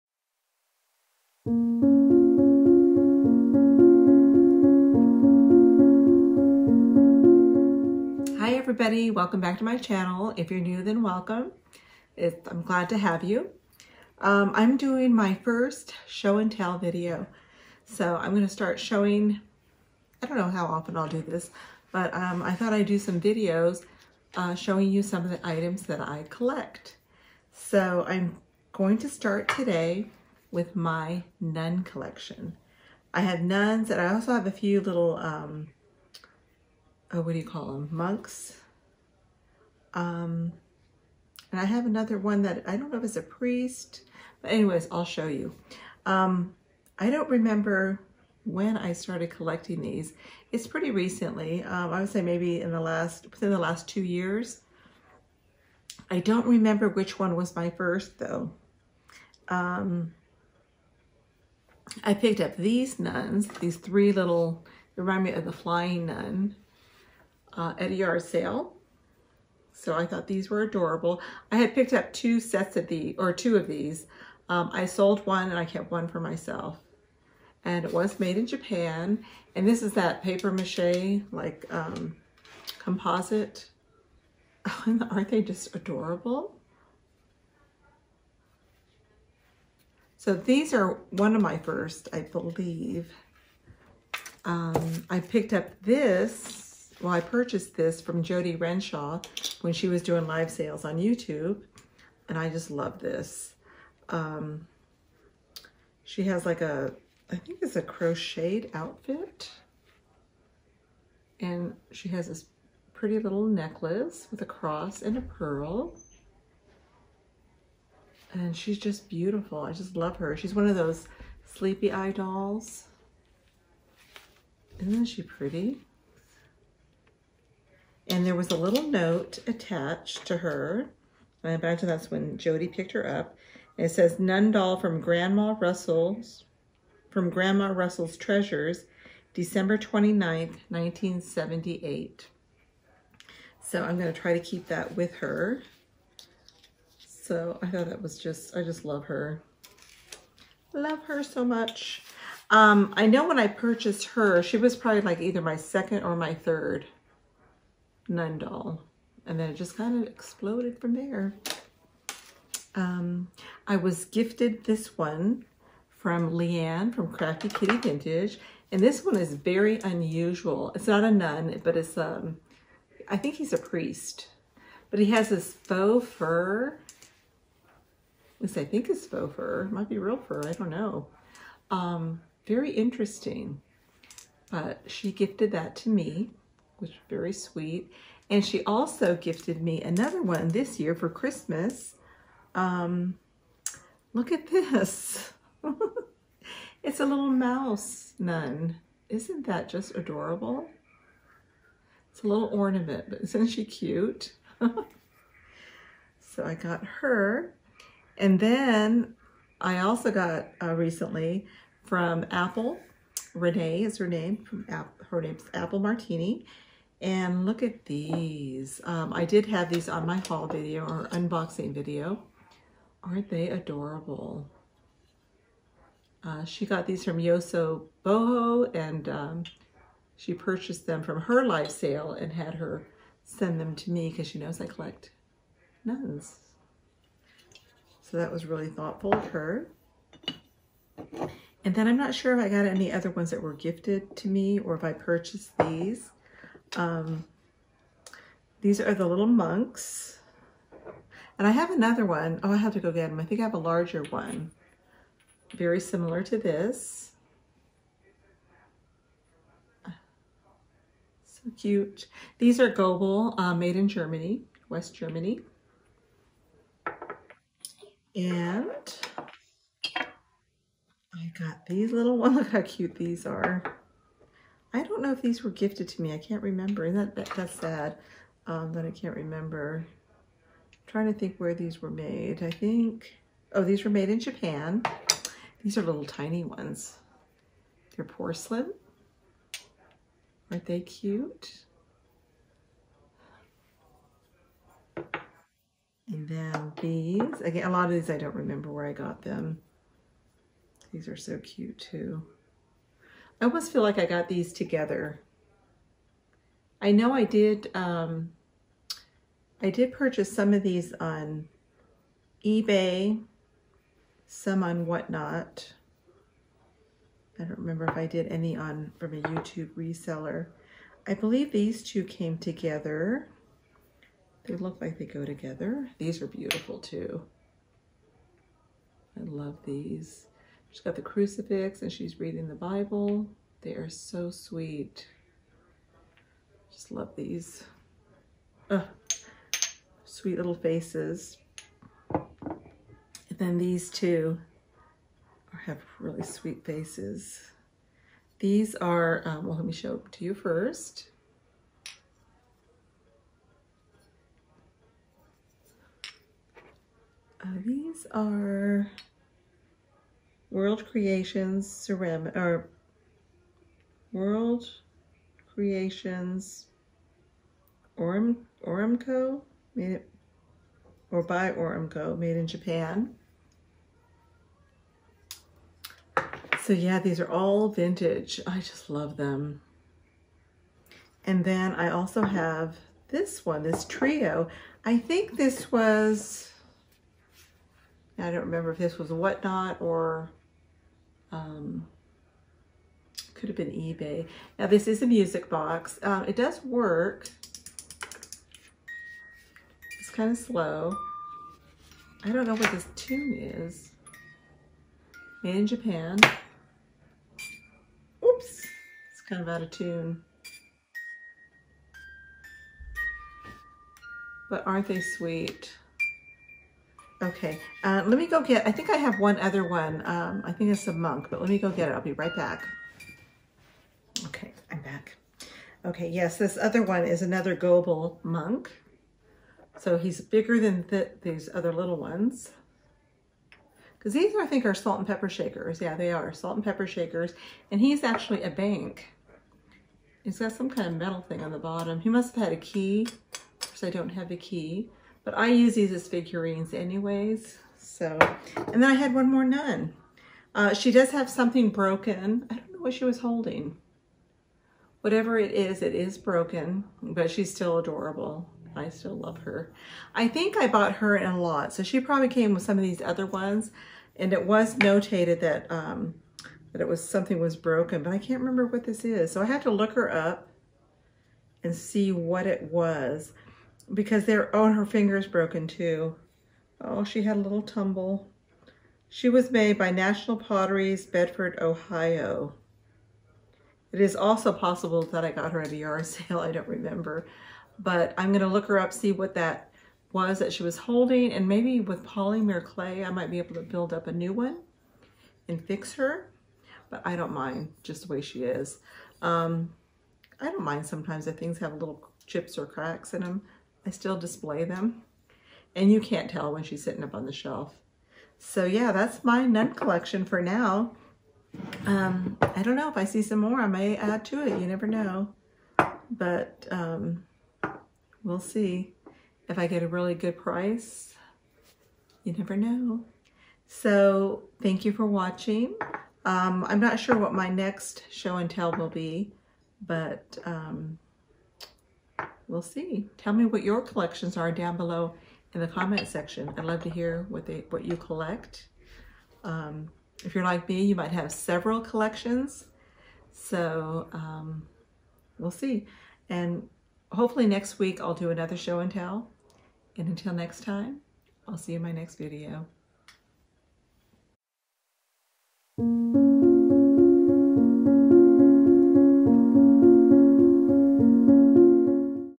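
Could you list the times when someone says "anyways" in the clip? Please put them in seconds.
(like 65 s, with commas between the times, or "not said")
44 s, 446 s.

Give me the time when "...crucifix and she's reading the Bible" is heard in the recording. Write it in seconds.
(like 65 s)
331 s.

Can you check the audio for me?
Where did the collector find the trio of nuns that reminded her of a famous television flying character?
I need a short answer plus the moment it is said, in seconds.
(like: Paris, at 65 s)
A yard sale, at 67 s.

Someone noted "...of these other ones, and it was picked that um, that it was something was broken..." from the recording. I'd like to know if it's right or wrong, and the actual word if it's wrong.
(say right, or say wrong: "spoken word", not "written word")
wrong: "notated", not "picked".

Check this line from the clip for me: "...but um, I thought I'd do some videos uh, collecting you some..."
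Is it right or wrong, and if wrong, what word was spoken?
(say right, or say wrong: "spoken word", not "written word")
wrong: "showing", not "collecting".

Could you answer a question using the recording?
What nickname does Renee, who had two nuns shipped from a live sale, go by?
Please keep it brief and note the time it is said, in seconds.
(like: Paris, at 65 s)
Apple Martini, at 215 s.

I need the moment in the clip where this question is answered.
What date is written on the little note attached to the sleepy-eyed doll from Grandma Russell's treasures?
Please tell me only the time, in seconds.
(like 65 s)
139 s.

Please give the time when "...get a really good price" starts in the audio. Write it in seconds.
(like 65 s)
519 s.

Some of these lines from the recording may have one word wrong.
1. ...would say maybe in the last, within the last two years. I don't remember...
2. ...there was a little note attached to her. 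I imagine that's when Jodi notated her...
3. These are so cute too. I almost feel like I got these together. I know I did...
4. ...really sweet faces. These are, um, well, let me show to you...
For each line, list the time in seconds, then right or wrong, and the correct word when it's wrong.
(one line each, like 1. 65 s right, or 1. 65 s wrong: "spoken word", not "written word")
1. 51 s right
2. 128 s wrong: "picked", not "notated"
3. 300 s right
4. 345 s right.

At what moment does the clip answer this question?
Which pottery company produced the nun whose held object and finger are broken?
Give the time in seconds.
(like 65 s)
479 s.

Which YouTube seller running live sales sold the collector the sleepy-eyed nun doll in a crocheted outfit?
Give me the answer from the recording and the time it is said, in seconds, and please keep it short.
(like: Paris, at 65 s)
Jodi Renshaw, at 98 s.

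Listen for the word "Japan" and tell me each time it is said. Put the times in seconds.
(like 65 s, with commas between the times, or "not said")
78 s, 284 s, 372 s, 405 s.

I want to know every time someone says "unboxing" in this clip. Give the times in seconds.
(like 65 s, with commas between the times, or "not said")
221 s.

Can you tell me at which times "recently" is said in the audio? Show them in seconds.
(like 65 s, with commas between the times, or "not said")
50 s, 210 s.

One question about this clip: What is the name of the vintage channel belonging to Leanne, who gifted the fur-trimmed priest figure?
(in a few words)
Crafty Kitty Vintage.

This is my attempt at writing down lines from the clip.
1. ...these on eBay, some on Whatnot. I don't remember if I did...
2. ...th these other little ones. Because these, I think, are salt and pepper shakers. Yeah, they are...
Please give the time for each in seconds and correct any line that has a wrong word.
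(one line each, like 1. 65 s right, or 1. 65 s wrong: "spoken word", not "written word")
1. 310 s right
2. 430 s right.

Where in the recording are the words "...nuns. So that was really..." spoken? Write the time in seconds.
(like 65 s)
235 s.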